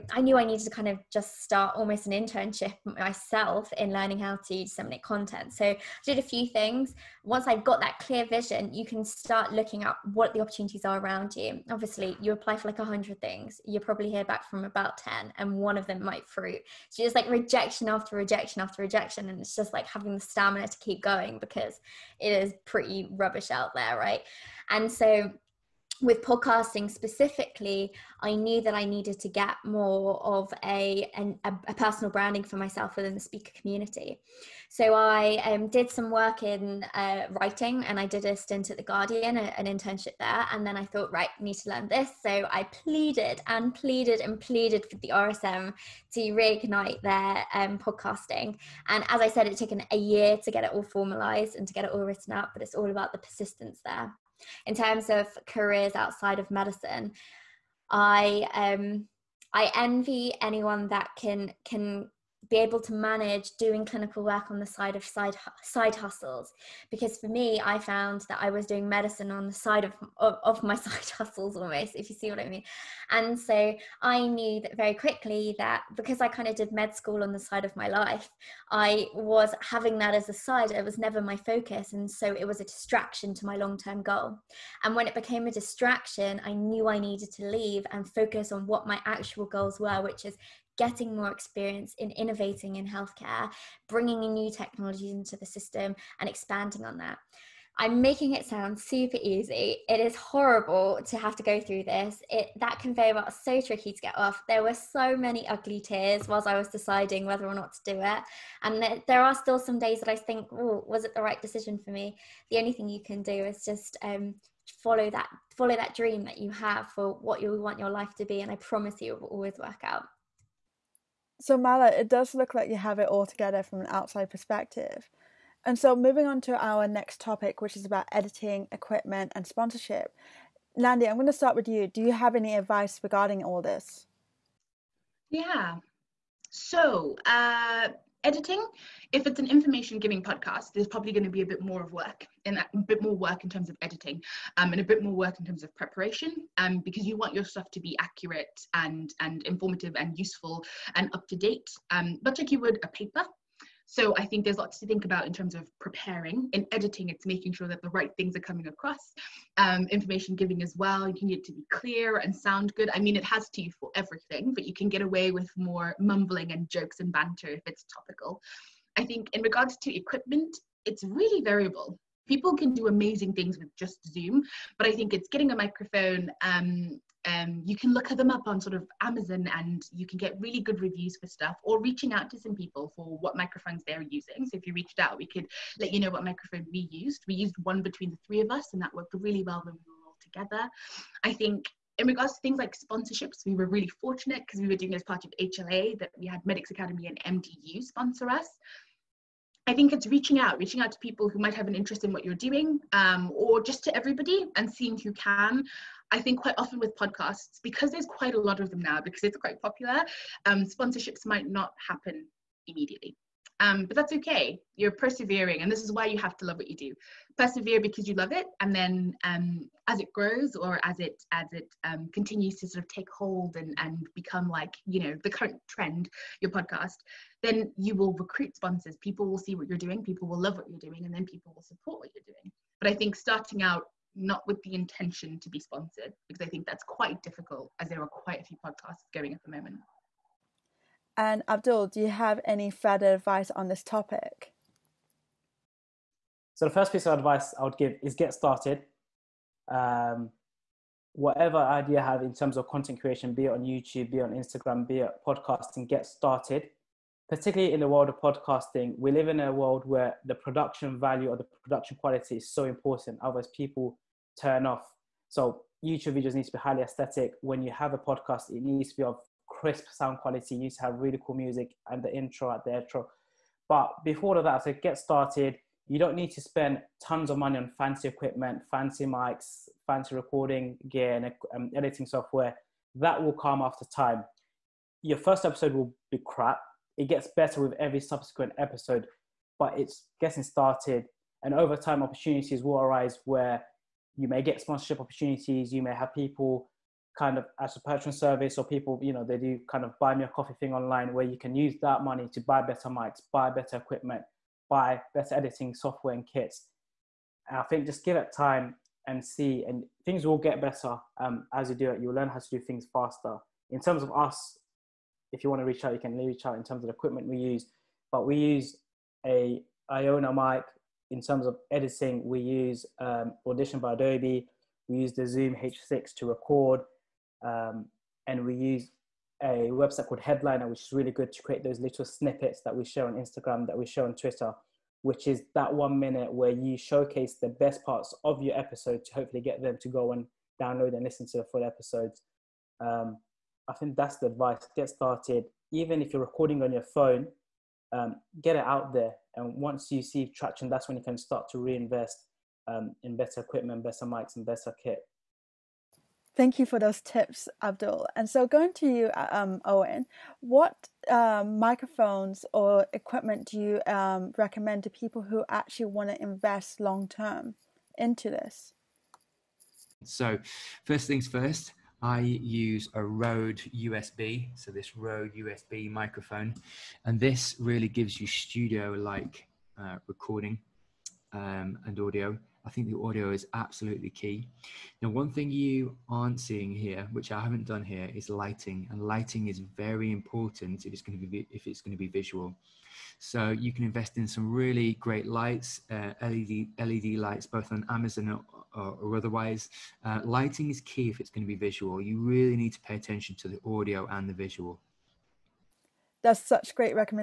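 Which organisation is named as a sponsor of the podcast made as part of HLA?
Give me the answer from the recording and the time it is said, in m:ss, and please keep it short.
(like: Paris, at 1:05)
Medics Academy, at 3:16.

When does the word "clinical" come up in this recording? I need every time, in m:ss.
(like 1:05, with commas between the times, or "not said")
1:03.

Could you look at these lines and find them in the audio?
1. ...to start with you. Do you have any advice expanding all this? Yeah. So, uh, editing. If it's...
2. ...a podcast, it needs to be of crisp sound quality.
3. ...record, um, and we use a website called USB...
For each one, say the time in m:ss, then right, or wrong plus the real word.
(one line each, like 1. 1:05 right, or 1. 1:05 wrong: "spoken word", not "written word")
1. 2:11 wrong: "regarding", not "expanding"
2. 4:27 right
3. 5:26 wrong: "Headliner", not "USB".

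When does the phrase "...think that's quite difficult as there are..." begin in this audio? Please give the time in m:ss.
3:56.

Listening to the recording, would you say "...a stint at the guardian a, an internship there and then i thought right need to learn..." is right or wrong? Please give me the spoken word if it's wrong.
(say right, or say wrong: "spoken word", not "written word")
right.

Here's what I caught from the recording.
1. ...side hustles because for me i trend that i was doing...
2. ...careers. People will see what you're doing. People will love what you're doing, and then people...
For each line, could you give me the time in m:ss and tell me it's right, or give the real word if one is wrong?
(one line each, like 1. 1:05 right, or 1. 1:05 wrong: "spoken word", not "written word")
1. 1:05 wrong: "found", not "trend"
2. 3:48 wrong: "sponsors", not "careers".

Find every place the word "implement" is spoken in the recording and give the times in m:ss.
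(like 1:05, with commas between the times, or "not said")
not said.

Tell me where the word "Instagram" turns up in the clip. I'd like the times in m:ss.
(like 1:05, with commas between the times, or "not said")
4:14, 5:33.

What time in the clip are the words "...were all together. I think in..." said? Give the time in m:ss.
3:09.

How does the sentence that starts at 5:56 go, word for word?
Thank you for those tips, Abdul.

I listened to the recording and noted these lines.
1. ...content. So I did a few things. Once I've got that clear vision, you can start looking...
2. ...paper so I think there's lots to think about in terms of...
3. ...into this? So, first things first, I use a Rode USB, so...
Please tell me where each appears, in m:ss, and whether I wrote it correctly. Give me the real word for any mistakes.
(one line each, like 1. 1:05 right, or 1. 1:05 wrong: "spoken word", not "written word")
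1. 0:05 right
2. 2:32 right
3. 6:07 right.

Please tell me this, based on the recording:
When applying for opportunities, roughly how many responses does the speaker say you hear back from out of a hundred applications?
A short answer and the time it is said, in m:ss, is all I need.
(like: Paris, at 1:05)
10, at 0:14.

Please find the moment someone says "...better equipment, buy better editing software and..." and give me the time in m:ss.
5:03.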